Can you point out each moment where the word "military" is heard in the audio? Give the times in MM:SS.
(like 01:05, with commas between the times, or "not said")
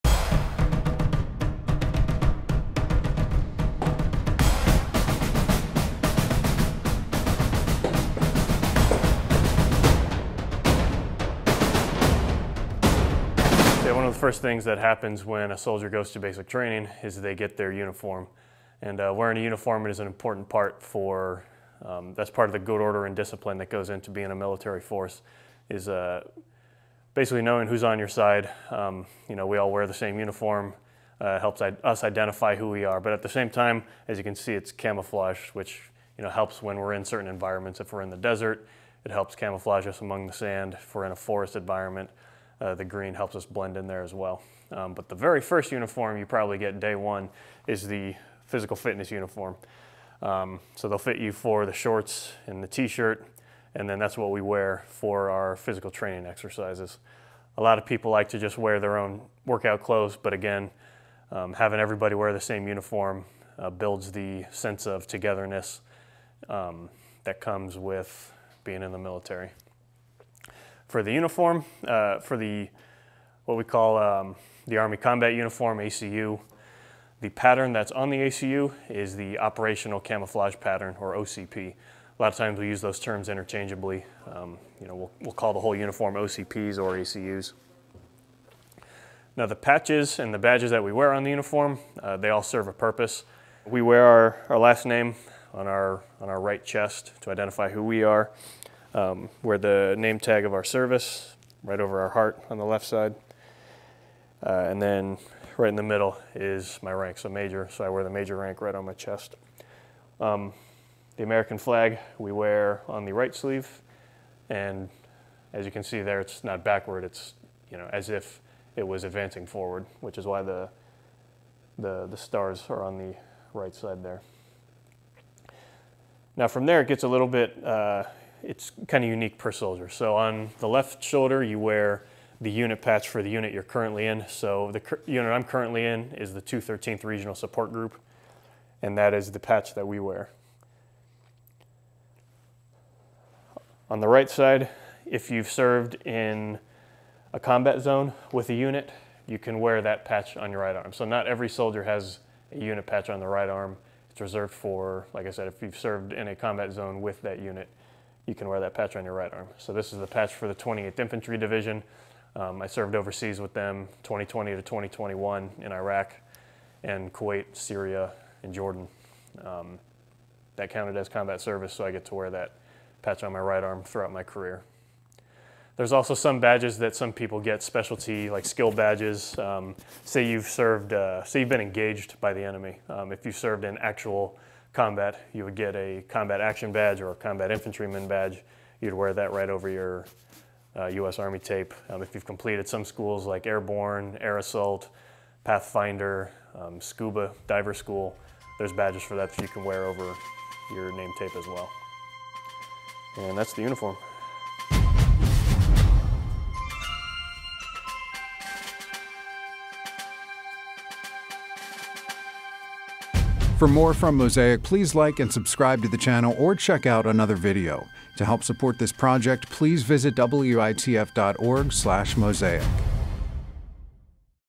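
00:24, 01:08.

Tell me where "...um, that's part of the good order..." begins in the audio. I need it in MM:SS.
00:21.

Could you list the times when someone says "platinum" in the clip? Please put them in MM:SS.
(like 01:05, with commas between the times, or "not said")
not said.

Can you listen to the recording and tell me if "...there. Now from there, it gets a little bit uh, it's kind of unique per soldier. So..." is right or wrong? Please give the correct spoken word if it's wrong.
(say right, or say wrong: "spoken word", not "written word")
right.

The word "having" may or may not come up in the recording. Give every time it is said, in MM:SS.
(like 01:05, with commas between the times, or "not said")
01:01.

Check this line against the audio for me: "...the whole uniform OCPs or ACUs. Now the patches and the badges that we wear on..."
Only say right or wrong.
right.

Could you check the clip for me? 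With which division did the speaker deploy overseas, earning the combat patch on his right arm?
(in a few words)
28th Infantry Division.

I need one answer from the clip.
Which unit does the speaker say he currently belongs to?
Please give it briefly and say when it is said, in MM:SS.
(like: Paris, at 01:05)
213th Regional Support Group, at 02:16.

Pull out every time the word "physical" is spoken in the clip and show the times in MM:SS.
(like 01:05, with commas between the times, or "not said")
00:48, 00:55.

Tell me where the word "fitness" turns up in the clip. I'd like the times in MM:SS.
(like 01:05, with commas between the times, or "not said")
00:48.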